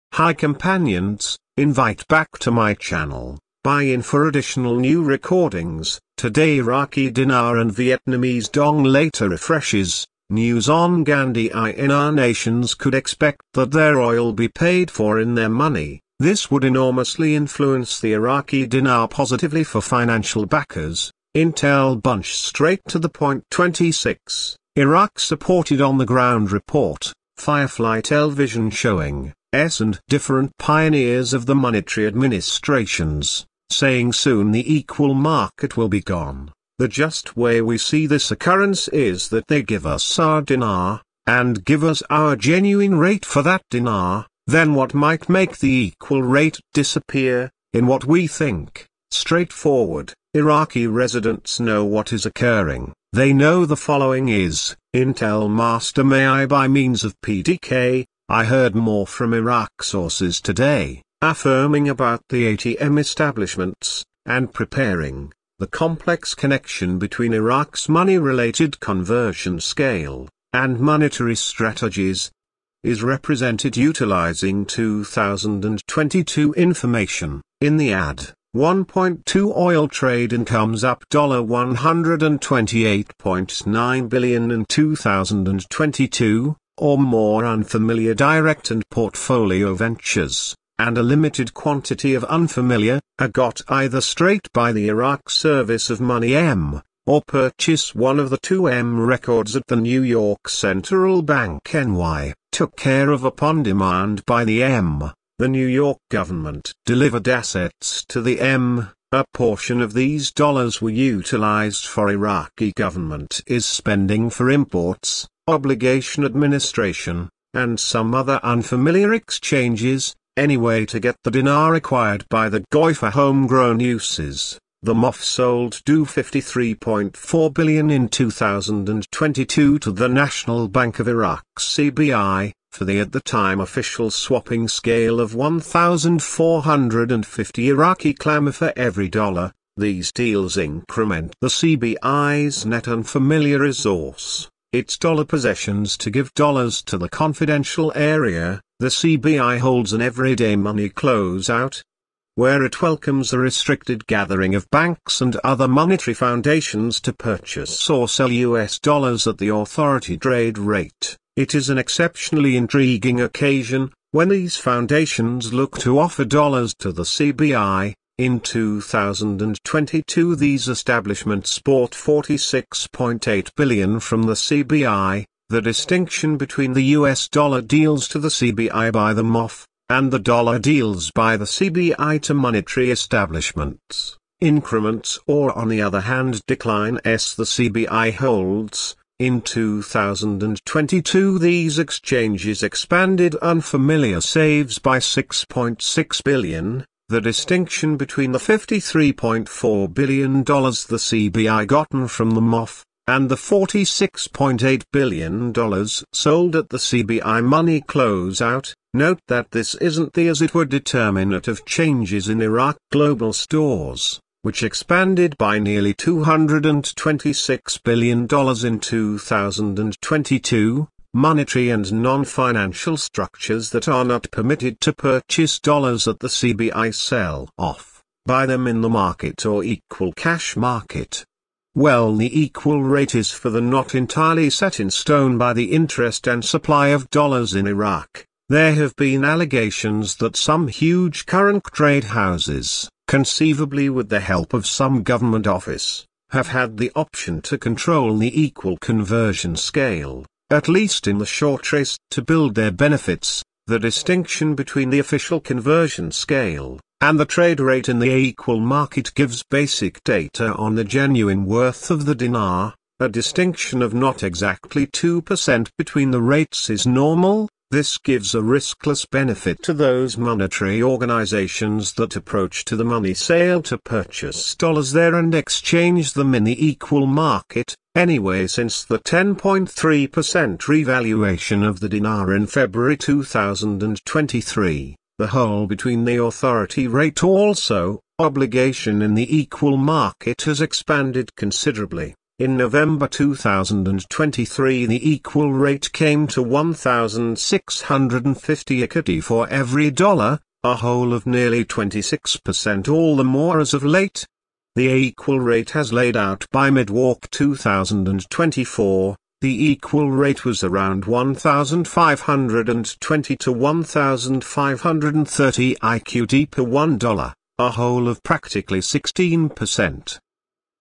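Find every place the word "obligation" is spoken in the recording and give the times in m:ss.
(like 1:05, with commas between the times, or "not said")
1:55, 4:48.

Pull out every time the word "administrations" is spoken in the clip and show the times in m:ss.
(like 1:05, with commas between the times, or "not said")
0:32, 1:56.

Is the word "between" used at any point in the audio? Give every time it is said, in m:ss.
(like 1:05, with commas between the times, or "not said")
1:06, 2:56, 3:17, 4:14, 4:25, 4:45.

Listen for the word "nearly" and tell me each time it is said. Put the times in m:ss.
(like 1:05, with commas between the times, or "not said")
3:35, 5:01.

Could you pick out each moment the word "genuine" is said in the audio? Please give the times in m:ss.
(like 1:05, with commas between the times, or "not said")
0:42, 4:20.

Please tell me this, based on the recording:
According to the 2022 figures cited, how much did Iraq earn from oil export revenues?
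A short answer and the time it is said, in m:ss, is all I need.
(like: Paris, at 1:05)
$128.9 billion, at 1:21.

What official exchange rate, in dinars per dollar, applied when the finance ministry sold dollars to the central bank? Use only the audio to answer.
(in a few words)
1,450.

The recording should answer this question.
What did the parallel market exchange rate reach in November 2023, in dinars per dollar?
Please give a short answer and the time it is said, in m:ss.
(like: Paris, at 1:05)
1,650, at 4:56.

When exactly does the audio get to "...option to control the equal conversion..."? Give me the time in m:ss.
4:06.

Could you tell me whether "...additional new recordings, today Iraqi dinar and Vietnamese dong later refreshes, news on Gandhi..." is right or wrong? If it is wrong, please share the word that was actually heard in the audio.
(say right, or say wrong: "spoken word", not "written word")
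right.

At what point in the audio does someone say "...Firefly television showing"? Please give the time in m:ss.
0:27.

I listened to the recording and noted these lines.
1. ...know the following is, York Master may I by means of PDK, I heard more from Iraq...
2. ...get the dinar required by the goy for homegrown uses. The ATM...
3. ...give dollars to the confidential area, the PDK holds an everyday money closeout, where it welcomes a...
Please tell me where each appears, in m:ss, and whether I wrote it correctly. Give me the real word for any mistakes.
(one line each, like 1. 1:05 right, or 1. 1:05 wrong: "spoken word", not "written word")
1. 0:53 wrong: "Intel", not "York"
2. 2:00 wrong: "MOF", not "ATM"
3. 2:26 wrong: "CBI", not "PDK".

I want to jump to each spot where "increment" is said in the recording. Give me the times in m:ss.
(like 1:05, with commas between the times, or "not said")
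2:20, 3:04.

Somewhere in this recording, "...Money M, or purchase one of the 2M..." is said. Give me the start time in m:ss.
1:36.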